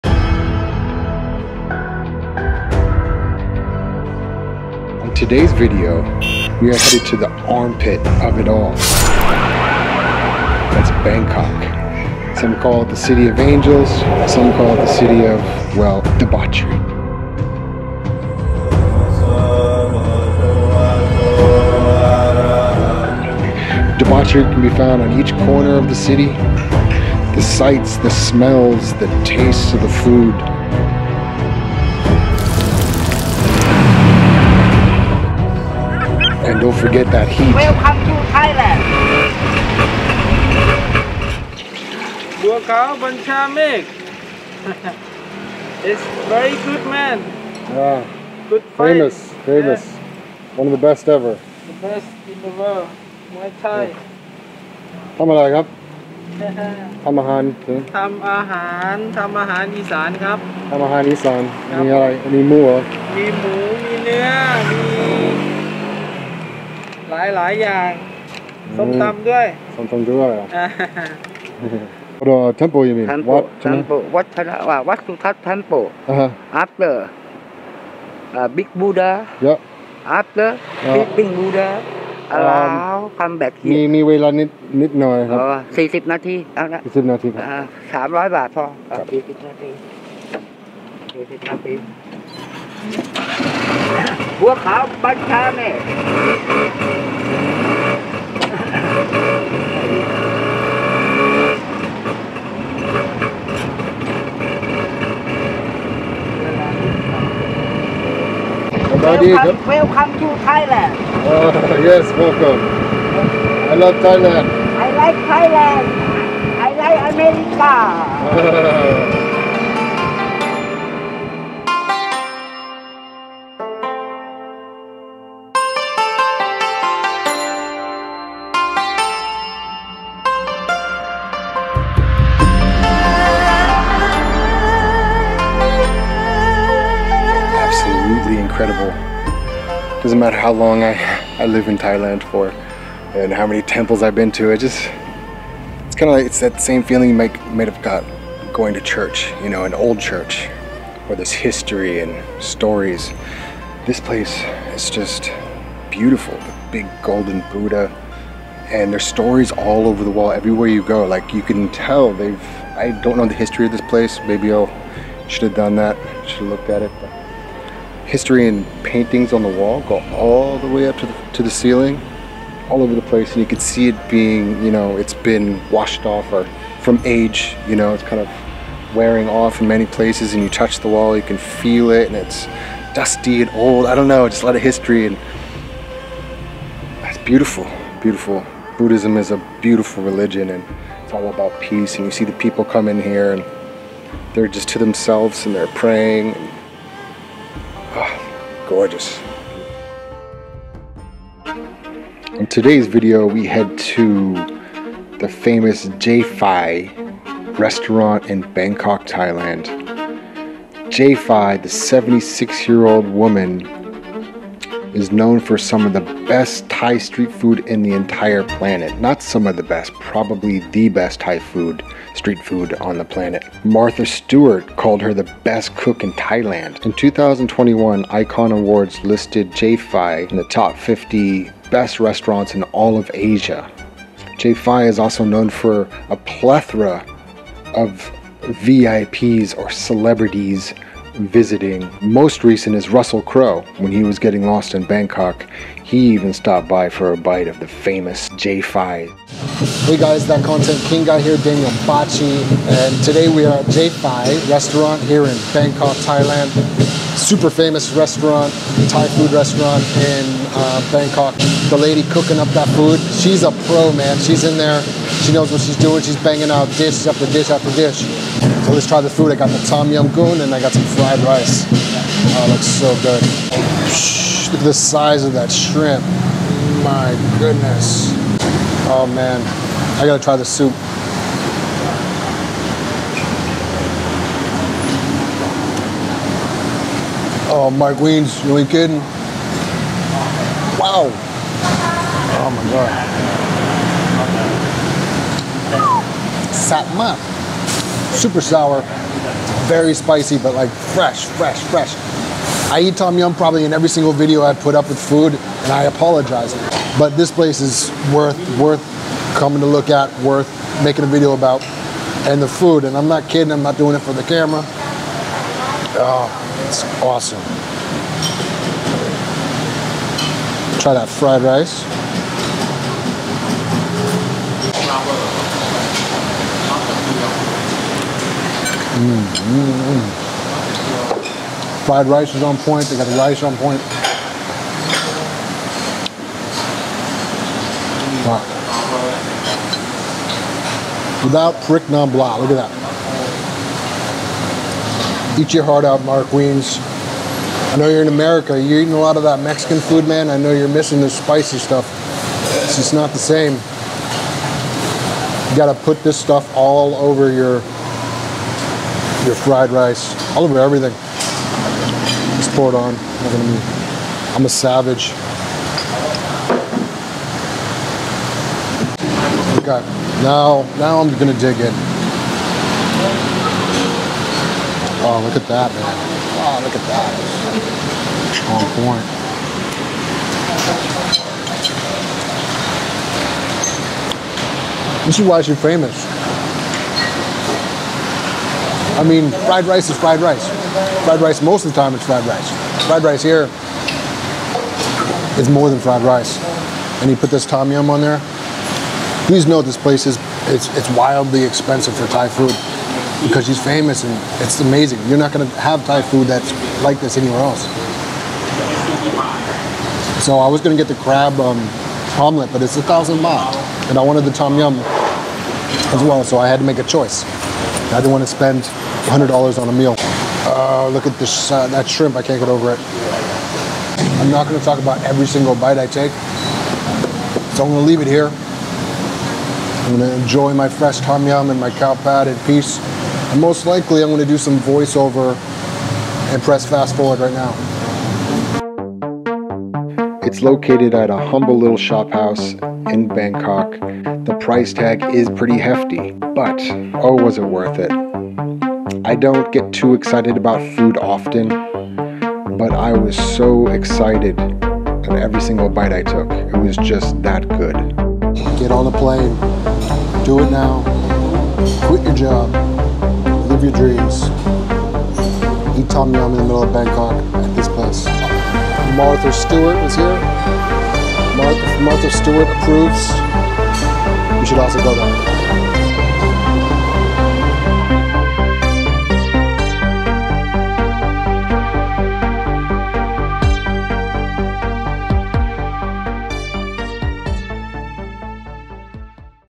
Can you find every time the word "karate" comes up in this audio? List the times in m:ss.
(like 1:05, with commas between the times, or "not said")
not said.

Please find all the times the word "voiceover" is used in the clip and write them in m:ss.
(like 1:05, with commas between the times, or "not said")
7:14.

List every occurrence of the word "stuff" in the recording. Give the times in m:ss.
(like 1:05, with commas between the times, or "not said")
5:51, 5:56.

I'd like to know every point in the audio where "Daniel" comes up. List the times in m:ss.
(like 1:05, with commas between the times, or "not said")
4:11.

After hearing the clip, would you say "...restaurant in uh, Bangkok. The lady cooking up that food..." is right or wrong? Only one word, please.
right.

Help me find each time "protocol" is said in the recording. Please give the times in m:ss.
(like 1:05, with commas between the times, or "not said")
not said.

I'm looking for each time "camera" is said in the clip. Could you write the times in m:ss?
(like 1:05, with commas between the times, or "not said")
5:14.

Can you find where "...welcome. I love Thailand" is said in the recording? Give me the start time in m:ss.
1:52.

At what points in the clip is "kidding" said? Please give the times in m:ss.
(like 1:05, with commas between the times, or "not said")
4:48, 5:13.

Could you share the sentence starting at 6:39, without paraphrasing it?
Please note this place is it's, it's wildly expensive for Thai food because she's famous and it's amazing.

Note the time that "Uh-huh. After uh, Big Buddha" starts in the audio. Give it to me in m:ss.
1:16.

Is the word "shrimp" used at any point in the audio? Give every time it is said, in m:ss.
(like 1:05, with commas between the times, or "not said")
4:35, 7:01.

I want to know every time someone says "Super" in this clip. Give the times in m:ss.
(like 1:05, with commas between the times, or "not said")
4:17, 4:58.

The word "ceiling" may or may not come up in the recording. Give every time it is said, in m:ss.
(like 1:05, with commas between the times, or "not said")
2:51.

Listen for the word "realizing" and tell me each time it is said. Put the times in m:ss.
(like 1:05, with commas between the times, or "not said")
not said.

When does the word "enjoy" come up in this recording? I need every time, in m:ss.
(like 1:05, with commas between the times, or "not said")
7:10.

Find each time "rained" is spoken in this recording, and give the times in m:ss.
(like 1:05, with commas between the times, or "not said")
not said.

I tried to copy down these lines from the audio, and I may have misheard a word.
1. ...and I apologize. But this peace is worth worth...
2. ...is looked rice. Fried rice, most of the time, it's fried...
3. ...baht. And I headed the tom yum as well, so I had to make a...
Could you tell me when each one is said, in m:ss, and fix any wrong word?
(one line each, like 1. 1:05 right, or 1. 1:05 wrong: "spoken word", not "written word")
1. 5:05 wrong: "place", not "peace"
2. 6:29 wrong: "fried", not "looked"
3. 6:53 wrong: "wanted", not "headed".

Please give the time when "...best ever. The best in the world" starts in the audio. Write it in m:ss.
0:50.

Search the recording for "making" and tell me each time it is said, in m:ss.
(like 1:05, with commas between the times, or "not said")
5:10.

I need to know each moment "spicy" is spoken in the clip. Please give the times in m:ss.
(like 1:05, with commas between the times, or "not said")
4:59, 5:51.